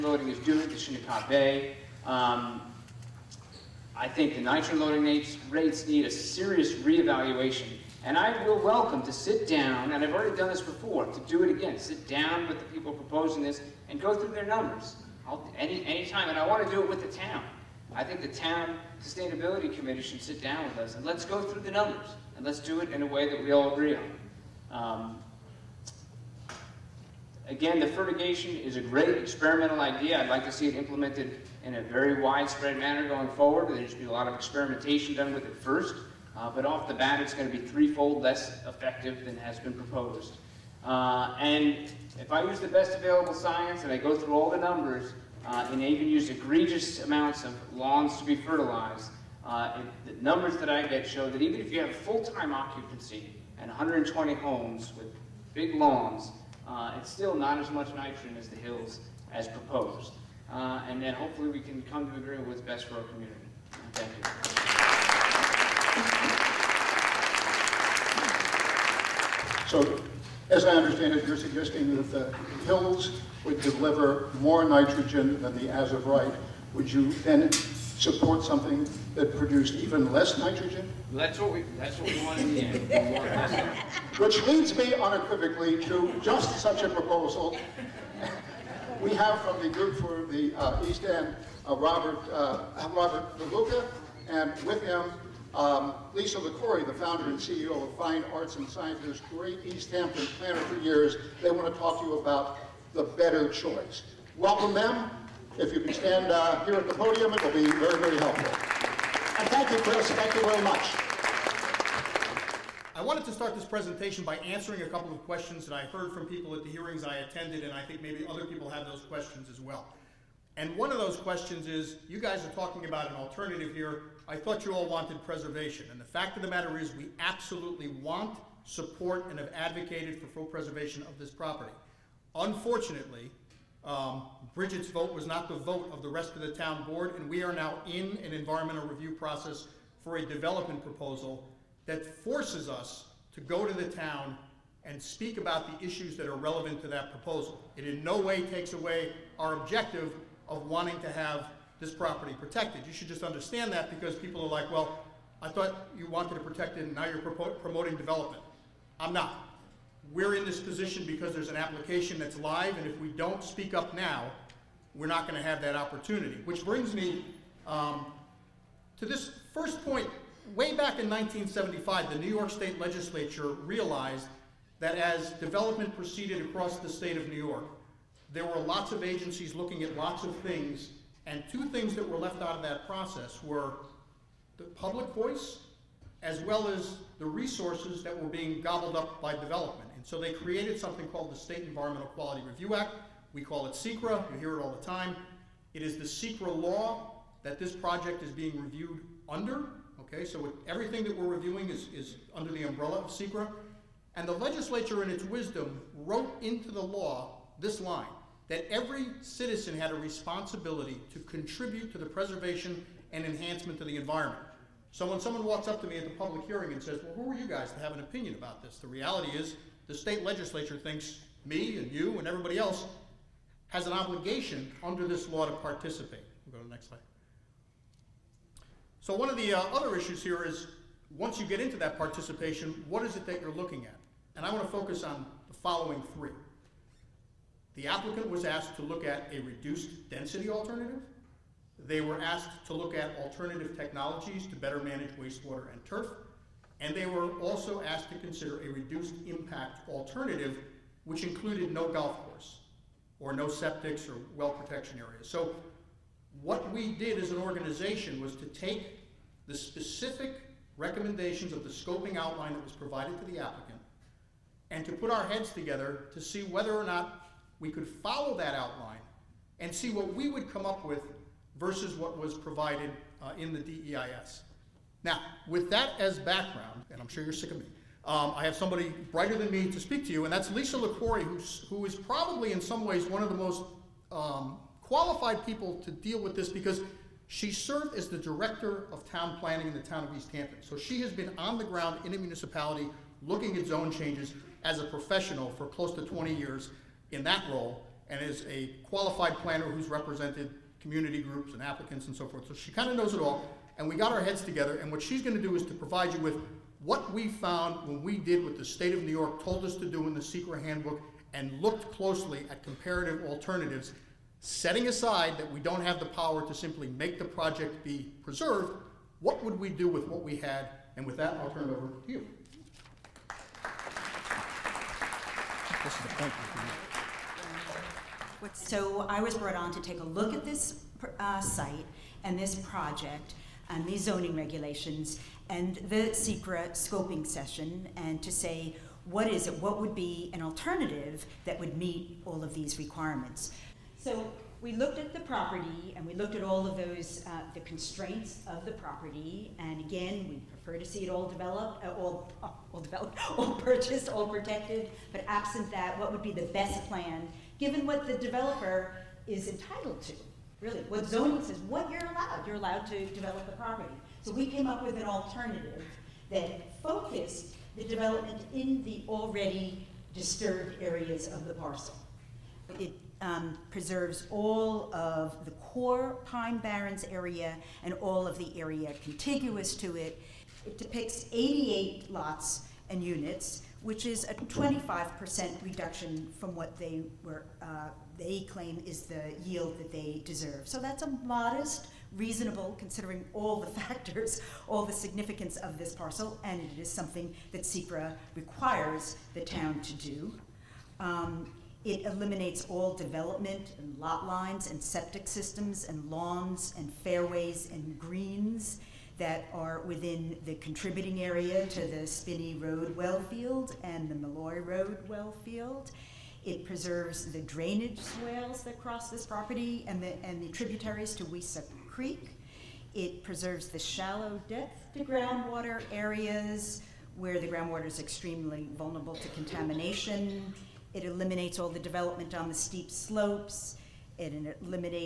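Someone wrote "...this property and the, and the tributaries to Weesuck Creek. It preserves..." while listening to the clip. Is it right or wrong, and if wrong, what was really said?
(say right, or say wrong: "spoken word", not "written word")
right.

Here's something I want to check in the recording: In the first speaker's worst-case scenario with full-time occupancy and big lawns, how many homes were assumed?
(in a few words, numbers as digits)
120.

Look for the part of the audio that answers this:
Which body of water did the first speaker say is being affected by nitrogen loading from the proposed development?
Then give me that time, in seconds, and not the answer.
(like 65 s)
0 s.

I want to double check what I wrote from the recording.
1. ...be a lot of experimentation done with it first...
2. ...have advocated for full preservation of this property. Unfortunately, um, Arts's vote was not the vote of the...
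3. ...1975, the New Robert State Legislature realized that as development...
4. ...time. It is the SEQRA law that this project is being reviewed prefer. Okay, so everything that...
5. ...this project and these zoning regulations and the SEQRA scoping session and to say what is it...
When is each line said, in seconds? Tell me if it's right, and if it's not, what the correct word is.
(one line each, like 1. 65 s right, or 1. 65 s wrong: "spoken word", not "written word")
1. 33 s right
2. 129 s wrong: "Bridget", not "Arts"
3. 171 s wrong: "York", not "Robert"
4. 194 s wrong: "under", not "prefer"
5. 332 s right.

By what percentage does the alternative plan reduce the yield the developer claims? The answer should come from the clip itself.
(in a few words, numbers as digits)
25%.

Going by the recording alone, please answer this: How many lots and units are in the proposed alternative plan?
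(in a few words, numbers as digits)
88.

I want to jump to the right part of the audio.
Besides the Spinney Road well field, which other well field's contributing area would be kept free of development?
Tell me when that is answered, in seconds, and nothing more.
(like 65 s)
414 s.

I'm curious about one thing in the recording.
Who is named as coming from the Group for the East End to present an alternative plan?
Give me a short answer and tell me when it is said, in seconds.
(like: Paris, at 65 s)
Robert DeLuca, at 92 s.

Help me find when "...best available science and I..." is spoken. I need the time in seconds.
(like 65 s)
42 s.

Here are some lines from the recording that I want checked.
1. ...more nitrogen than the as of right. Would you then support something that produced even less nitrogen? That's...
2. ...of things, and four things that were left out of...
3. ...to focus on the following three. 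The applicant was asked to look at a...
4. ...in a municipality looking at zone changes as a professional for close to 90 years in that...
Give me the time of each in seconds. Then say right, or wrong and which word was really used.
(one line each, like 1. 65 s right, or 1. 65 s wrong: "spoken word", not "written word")
1. 74 s right
2. 180 s wrong: "two", not "four"
3. 234 s right
4. 292 s wrong: "20", not "90".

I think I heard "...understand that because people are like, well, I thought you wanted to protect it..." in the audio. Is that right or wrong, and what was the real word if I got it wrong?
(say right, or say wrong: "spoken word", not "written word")
right.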